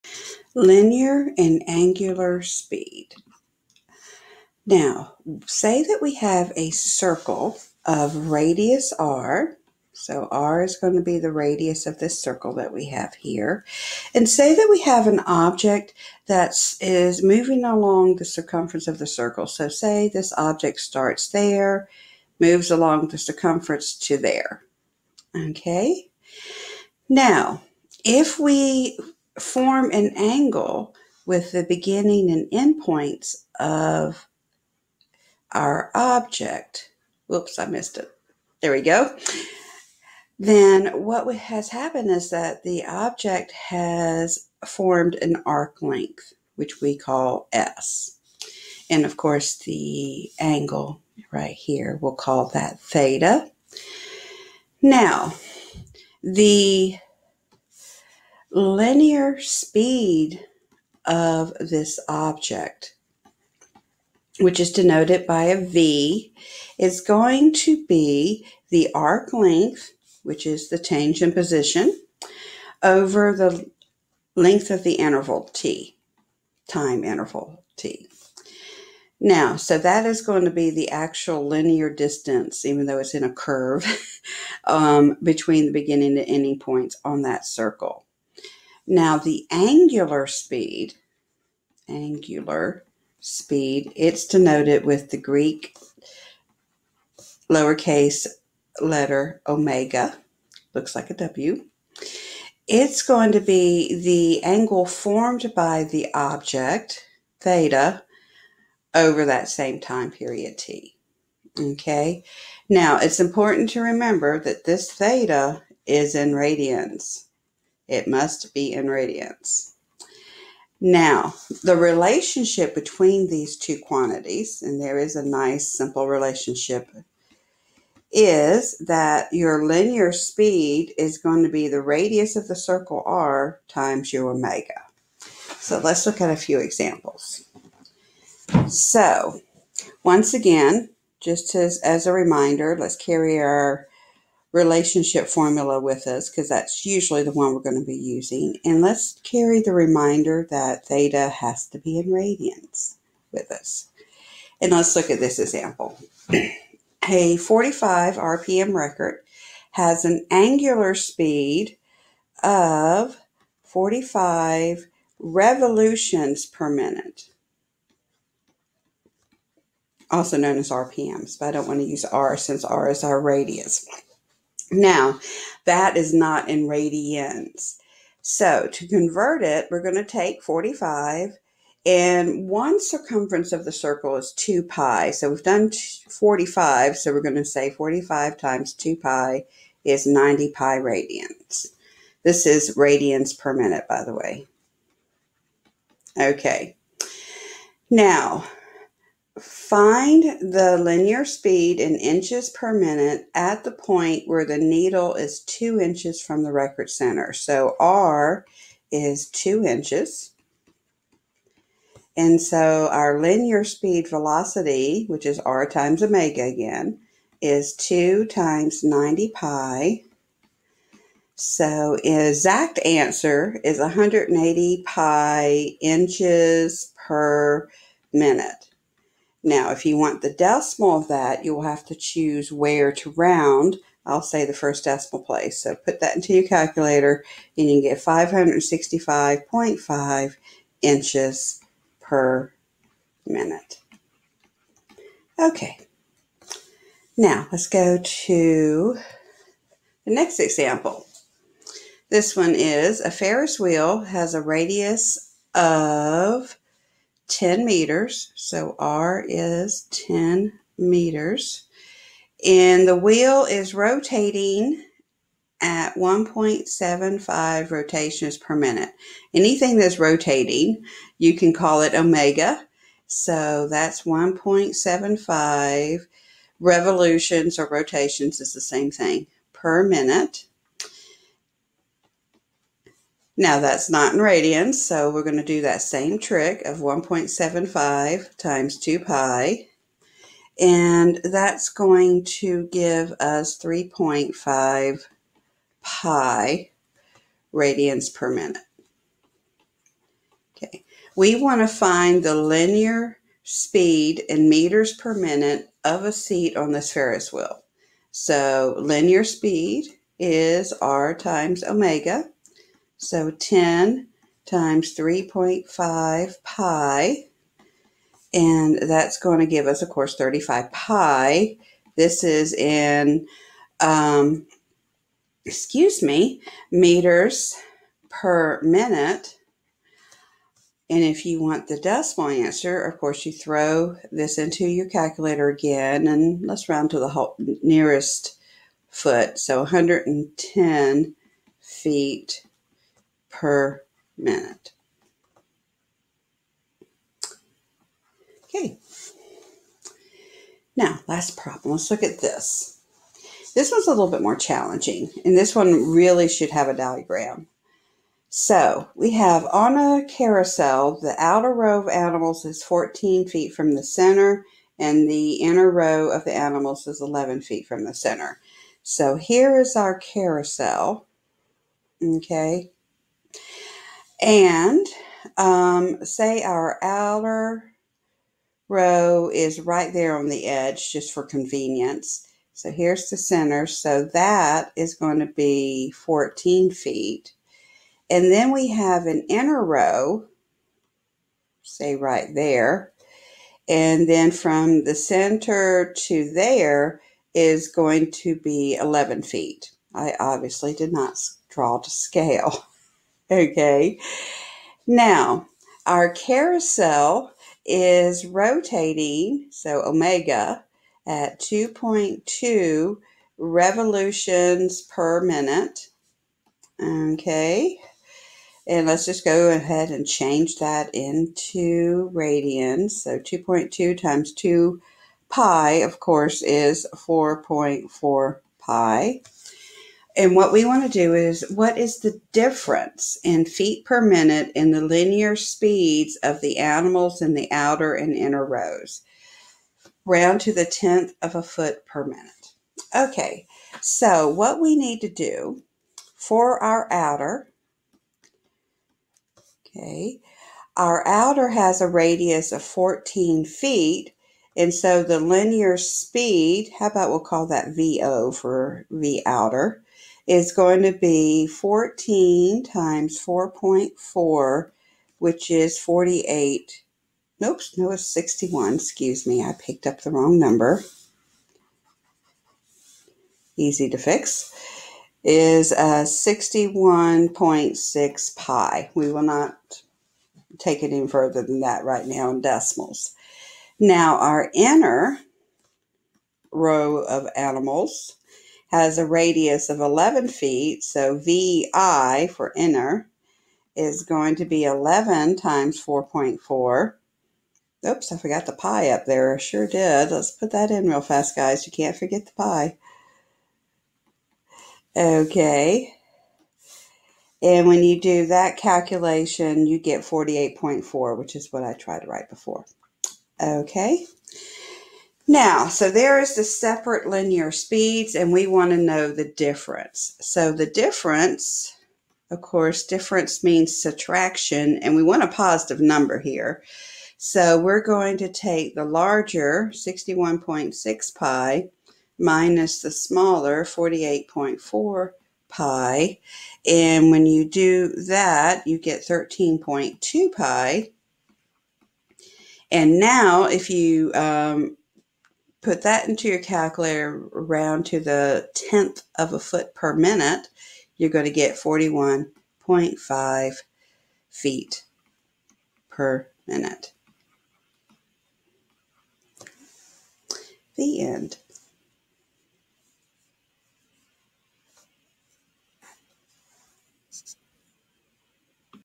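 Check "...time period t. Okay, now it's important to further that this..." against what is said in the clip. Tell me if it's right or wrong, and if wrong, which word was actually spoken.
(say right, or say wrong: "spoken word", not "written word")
wrong: "remember", not "further".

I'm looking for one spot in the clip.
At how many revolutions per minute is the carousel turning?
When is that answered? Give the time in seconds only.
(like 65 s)
411 s.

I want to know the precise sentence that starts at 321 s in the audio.
This is in, um, excuse me, meters per minute.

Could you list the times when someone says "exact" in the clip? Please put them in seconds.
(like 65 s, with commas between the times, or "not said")
222 s.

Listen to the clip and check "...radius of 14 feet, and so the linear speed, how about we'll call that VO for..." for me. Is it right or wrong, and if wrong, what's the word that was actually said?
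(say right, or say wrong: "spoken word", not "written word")
right.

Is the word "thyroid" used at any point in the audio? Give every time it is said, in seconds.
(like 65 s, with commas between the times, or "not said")
not said.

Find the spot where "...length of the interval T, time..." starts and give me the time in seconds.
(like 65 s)
74 s.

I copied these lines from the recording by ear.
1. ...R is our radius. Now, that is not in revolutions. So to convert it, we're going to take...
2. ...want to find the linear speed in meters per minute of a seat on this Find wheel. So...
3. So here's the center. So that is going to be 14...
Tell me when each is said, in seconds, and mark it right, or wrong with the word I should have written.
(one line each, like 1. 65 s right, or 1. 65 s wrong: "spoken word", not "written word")
1. 172 s wrong: "radians", not "revolutions"
2. 301 s wrong: "Ferris", not "Find"
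3. 382 s right.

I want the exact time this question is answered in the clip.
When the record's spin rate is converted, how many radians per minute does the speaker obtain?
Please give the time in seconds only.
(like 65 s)
190 s.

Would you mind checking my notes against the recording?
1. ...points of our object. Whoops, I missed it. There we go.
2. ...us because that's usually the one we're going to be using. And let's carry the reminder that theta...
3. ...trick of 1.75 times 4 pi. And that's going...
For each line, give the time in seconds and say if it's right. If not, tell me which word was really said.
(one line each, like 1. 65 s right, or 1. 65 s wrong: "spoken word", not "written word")
1. 32 s right
2. 146 s right
3. 286 s wrong: "2", not "4".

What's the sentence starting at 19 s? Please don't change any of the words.
So say this object starts there, moves along the circumference to there.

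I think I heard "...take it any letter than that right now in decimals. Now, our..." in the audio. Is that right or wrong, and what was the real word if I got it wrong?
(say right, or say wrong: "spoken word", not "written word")
wrong: "further", not "letter".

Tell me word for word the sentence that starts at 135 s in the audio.
So let's look at a few examples.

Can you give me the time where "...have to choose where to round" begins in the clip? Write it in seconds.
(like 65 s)
231 s.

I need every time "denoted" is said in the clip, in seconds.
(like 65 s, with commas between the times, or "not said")
64 s, 94 s.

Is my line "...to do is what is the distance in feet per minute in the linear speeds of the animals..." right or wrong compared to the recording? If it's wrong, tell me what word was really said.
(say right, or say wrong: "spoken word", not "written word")
wrong: "difference", not "distance".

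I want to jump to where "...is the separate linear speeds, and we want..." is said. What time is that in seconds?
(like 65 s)
516 s.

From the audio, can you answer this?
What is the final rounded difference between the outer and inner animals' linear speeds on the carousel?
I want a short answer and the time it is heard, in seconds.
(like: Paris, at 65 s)
41.5 feet per minute, at 551 s.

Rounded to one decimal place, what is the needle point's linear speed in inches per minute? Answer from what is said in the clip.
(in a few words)
565.5.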